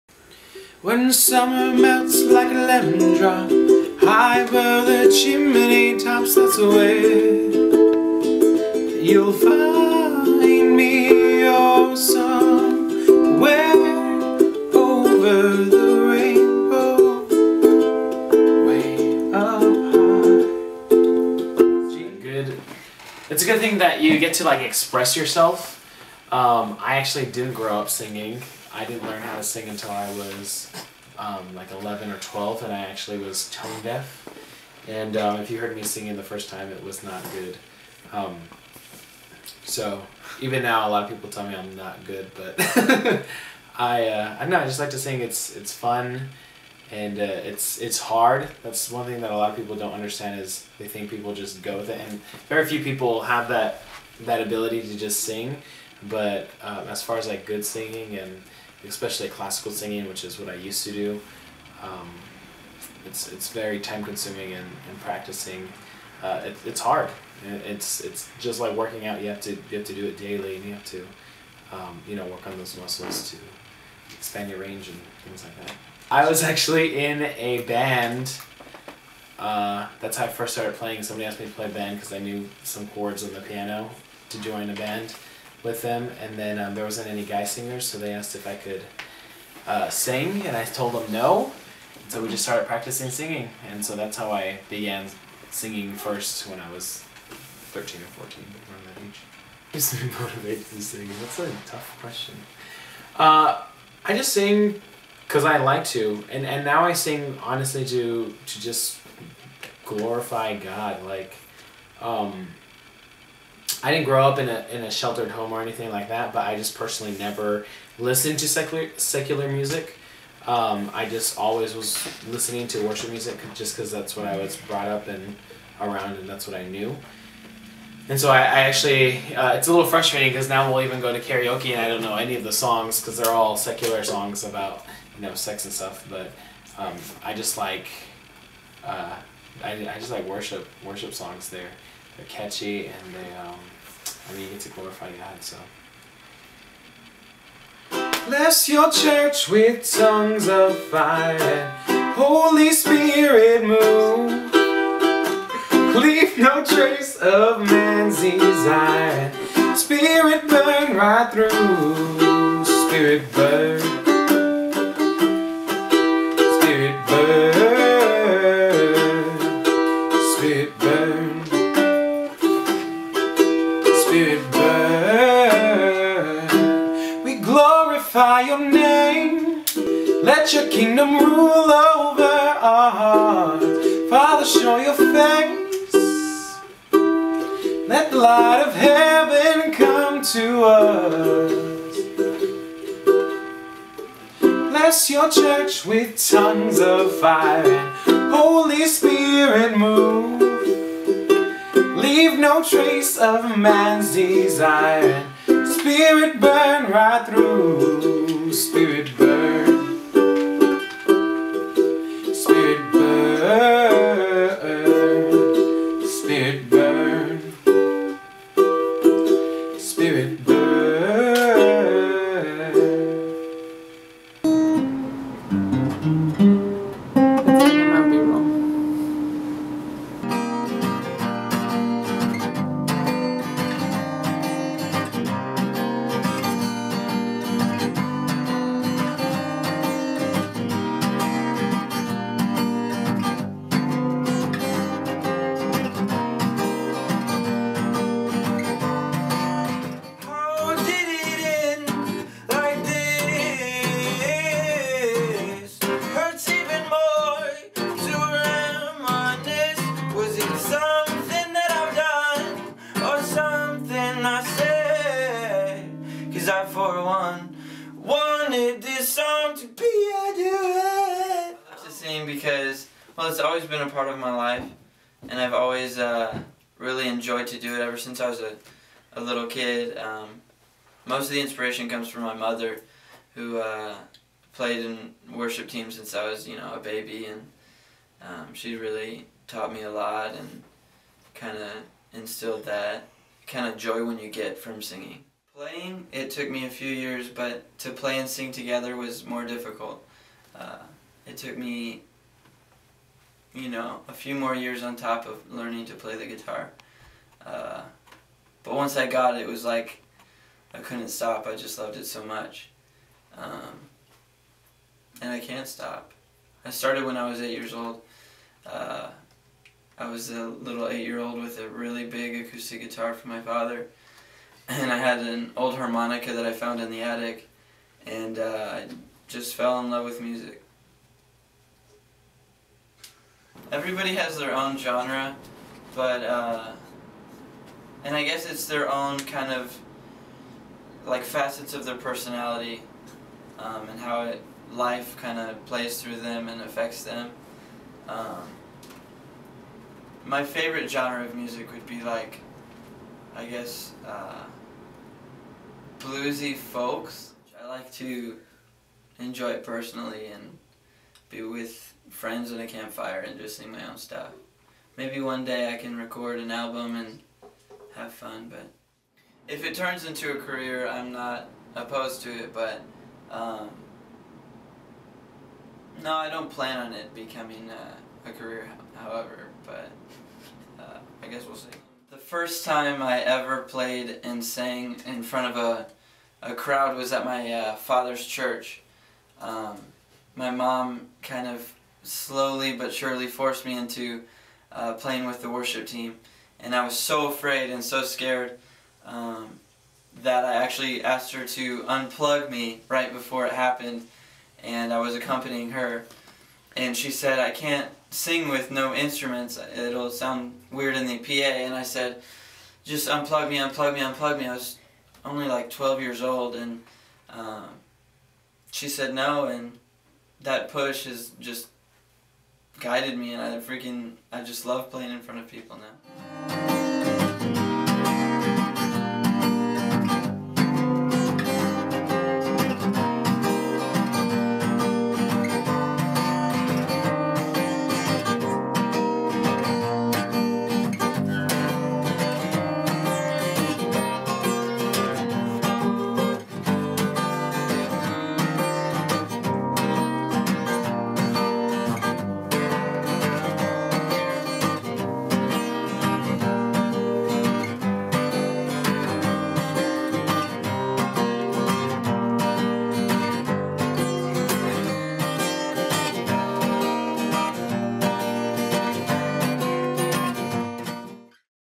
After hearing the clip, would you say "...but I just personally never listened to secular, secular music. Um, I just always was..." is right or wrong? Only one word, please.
right.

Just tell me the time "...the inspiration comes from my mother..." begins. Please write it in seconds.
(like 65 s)
281 s.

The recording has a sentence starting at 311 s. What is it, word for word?
I just loved it so much.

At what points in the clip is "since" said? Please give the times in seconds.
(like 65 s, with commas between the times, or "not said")
277 s, 285 s.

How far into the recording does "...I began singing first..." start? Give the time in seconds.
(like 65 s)
94 s.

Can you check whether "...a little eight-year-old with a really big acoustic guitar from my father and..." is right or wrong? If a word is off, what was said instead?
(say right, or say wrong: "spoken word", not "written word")
right.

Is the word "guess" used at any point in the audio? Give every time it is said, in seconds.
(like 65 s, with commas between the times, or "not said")
338 s, 353 s, 381 s.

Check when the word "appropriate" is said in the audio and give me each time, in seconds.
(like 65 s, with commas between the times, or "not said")
not said.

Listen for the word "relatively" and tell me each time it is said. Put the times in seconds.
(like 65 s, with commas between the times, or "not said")
not said.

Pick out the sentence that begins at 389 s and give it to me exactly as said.
Um, my mom kind of slowly but surely forced me into uh, playing with the worship team.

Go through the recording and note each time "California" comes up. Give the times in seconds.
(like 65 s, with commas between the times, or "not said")
not said.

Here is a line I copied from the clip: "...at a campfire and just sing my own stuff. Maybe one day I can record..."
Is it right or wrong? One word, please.
right.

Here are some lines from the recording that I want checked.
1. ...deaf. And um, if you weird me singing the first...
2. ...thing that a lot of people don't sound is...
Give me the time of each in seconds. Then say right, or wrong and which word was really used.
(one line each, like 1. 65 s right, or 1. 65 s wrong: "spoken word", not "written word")
1. 33 s wrong: "heard", not "weird"
2. 49 s wrong: "understand", not "sound".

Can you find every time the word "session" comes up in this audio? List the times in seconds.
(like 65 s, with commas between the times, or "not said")
not said.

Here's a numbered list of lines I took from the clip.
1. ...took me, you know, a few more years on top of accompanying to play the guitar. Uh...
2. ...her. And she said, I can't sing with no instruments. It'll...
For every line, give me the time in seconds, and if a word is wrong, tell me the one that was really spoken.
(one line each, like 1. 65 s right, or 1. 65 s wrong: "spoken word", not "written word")
1. 301 s wrong: "learning", not "accompanying"
2. 405 s right.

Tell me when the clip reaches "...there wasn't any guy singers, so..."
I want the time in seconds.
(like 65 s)
86 s.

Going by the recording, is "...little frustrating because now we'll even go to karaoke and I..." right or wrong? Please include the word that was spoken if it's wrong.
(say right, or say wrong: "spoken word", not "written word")
right.